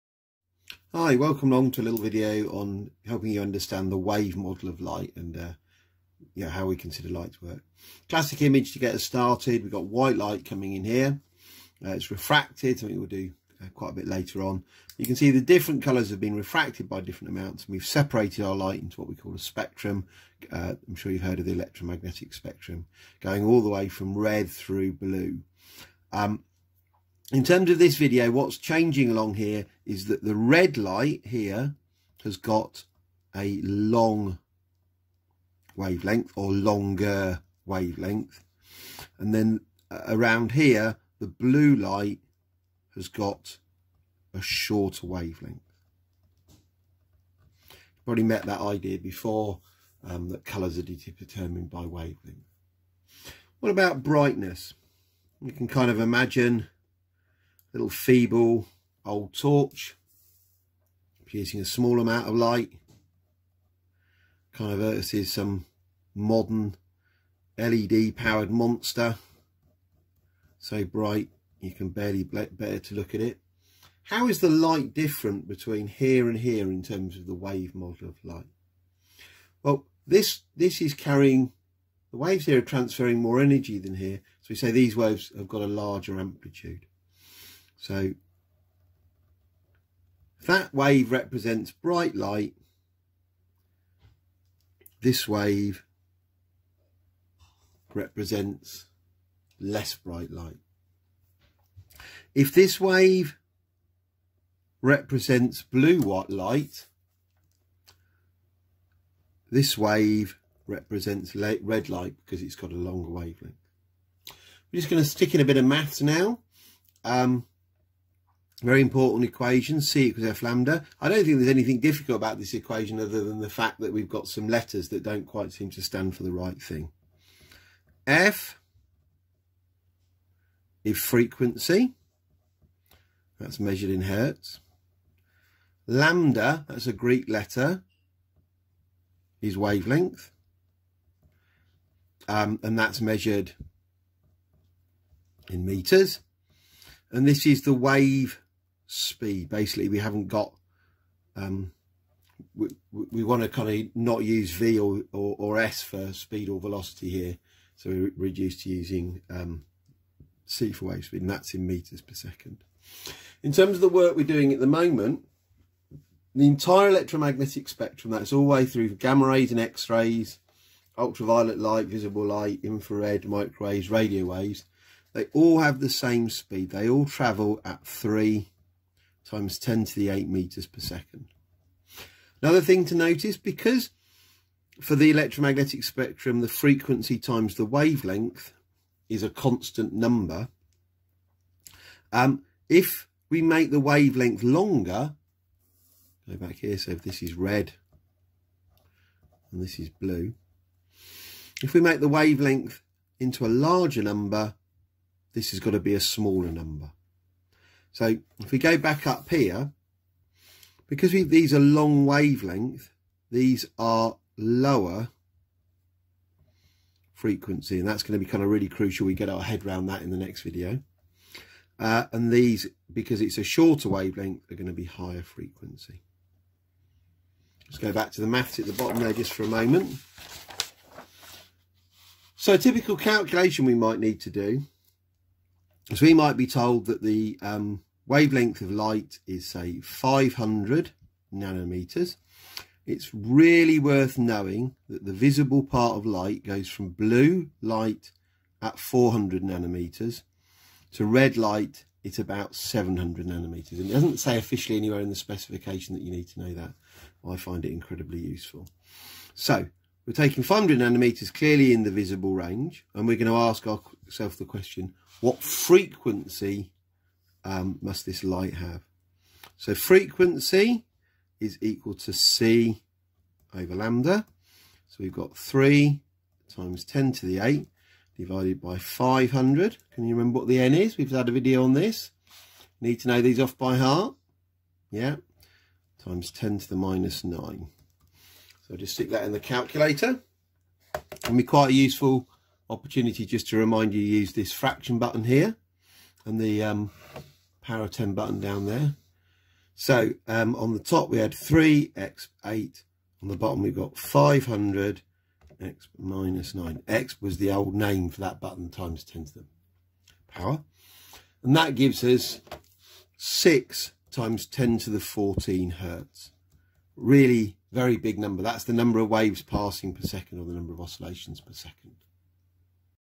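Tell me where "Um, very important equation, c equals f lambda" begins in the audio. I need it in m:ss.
1:57.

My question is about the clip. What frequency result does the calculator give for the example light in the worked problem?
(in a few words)
6 × 10^14 hertz.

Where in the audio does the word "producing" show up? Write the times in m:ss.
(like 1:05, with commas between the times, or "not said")
1:01.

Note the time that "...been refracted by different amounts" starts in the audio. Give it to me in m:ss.
0:16.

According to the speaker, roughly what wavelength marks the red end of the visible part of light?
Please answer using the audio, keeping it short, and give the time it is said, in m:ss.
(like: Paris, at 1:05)
700 nanometers, at 4:12.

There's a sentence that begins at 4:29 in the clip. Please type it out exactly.
So frequency is equal to C over lambda.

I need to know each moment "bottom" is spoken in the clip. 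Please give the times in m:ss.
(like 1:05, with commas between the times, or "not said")
3:48, 5:03.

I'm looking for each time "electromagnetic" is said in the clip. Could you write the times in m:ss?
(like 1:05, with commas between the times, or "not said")
0:21, 2:46, 3:05.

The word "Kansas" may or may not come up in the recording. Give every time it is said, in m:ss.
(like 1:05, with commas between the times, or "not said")
not said.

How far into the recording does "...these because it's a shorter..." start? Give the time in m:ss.
3:42.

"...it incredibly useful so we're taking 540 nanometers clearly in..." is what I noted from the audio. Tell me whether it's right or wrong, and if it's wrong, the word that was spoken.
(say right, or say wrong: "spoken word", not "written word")
wrong: "500", not "540".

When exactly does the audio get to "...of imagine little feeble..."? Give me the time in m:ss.
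0:55.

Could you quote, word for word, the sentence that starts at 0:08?
Classic image to get us started.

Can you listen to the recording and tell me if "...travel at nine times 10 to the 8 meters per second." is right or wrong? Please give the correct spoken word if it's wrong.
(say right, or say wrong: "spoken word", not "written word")
wrong: "three", not "nine".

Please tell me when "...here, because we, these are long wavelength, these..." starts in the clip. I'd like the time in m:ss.
3:29.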